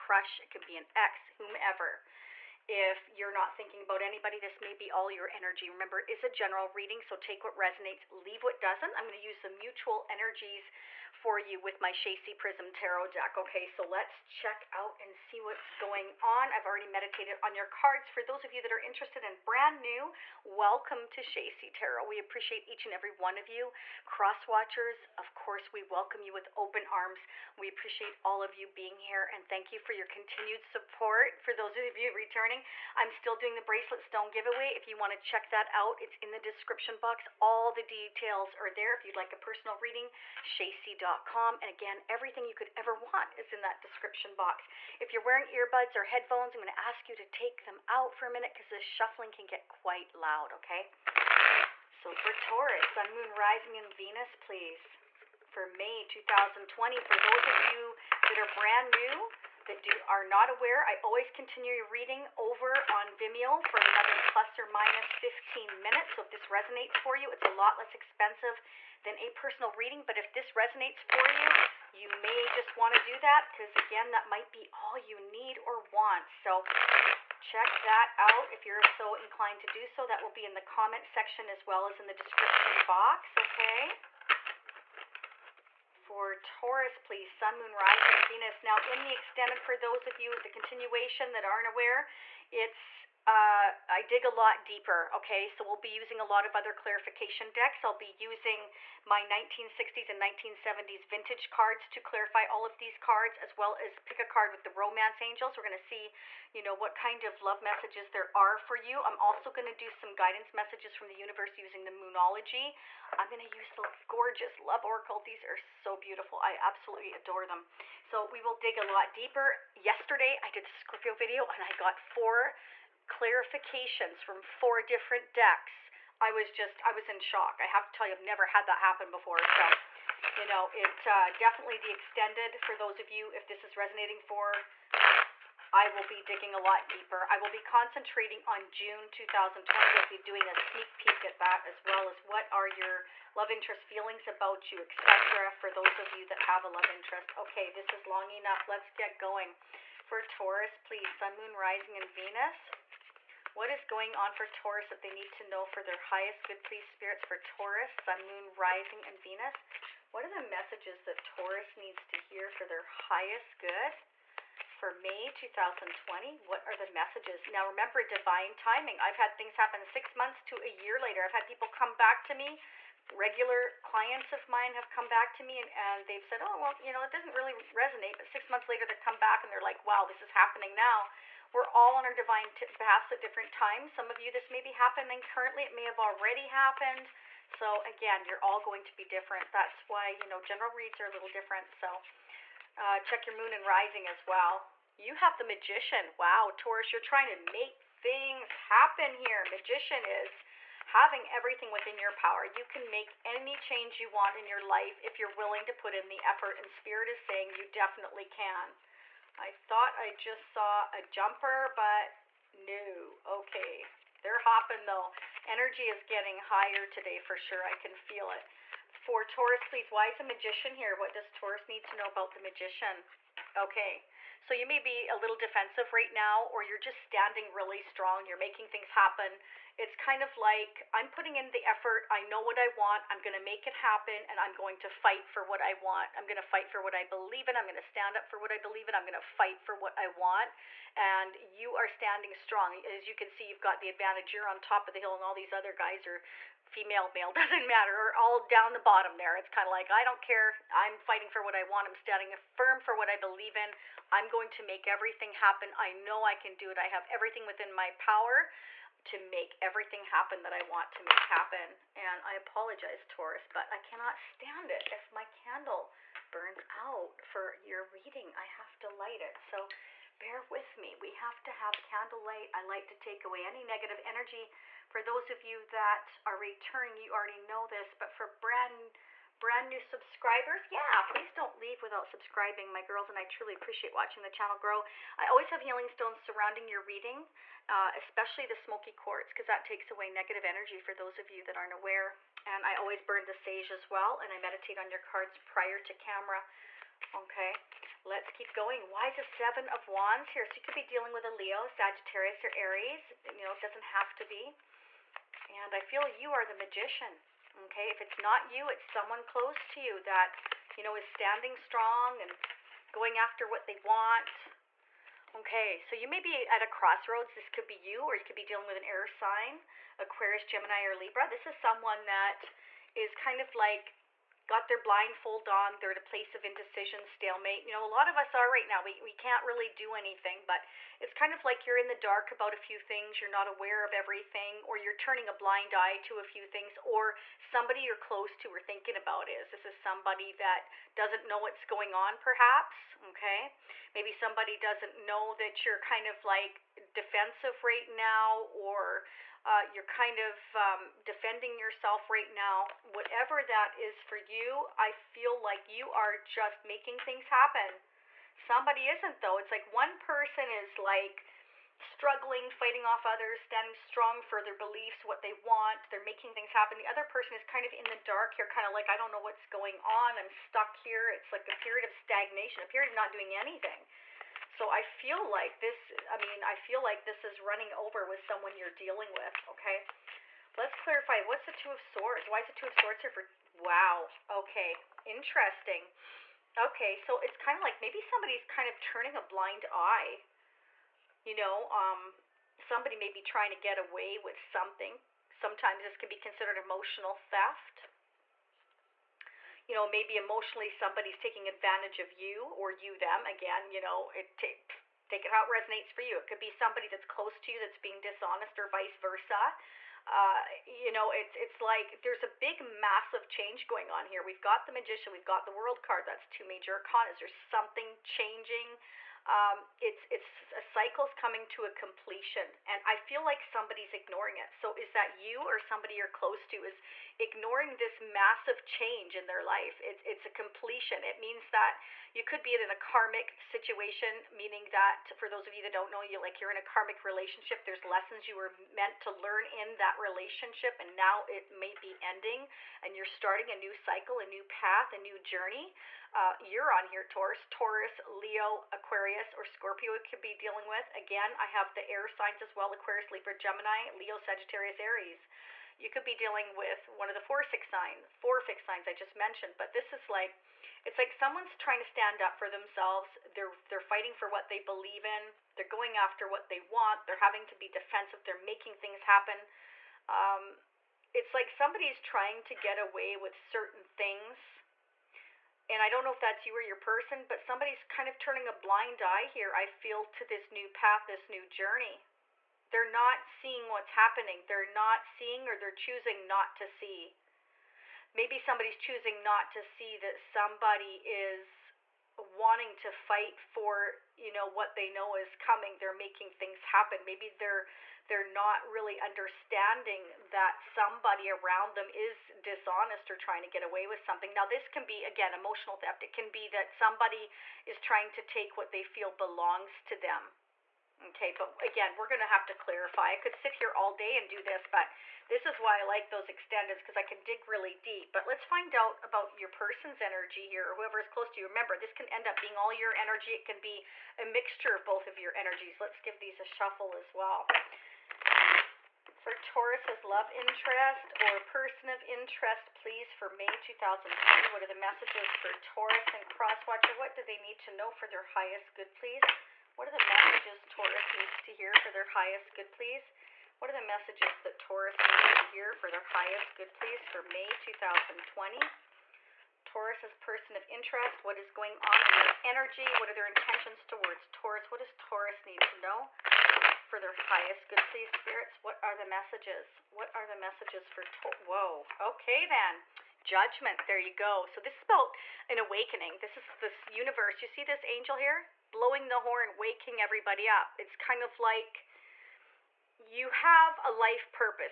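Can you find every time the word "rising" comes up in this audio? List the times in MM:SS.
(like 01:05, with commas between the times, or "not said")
00:53, 01:27, 02:31, 02:38, 03:13.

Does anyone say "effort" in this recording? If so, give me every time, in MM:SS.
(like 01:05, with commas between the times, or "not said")
03:26, 03:51.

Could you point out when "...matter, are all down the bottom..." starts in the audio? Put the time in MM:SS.
04:07.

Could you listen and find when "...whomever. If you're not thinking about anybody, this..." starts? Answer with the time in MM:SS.
00:01.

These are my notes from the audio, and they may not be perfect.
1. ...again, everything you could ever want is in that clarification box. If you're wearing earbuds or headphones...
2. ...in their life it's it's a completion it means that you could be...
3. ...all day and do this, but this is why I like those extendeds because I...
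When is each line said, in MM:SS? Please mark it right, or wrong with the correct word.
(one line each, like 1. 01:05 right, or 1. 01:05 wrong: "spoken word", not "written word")
1. 00:41 wrong: "description", not "clarification"
2. 07:09 right
3. 08:33 right.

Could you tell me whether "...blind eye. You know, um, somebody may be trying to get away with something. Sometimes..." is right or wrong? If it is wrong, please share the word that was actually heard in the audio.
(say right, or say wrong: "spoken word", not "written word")
right.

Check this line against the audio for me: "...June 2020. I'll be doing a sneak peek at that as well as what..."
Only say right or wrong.
right.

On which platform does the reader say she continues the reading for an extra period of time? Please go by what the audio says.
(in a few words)
Vimeo.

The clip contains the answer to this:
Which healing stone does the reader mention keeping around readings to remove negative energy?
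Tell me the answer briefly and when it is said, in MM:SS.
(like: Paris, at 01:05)
smoky quartz, at 04:48.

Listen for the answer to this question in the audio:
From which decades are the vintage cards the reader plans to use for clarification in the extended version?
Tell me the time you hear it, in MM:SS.
01:39.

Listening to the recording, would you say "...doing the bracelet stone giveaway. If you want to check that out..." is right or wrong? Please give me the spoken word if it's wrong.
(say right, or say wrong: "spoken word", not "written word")
right.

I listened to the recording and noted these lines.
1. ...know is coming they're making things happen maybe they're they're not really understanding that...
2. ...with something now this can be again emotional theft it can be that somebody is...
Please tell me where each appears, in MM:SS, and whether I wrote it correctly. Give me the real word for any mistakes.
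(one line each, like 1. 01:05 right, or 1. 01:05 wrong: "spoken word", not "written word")
1. 08:14 right
2. 08:23 right.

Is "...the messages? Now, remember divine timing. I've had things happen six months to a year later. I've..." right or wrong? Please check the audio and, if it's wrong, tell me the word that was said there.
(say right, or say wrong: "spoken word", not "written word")
right.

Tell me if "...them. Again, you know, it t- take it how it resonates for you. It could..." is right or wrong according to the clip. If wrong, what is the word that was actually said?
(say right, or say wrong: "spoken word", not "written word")
right.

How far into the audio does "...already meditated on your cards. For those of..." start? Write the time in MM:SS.
00:16.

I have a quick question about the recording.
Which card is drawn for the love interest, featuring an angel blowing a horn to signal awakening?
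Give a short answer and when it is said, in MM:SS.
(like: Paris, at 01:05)
Judgment, at 09:23.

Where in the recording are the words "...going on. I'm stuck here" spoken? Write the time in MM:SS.
06:09.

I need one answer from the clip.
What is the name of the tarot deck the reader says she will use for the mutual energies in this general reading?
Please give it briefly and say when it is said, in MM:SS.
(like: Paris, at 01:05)
Shasie Prism Tarot, at 00:11.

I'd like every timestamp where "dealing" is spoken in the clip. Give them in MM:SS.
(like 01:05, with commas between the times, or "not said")
05:00, 05:18, 06:18, 07:30, 07:36.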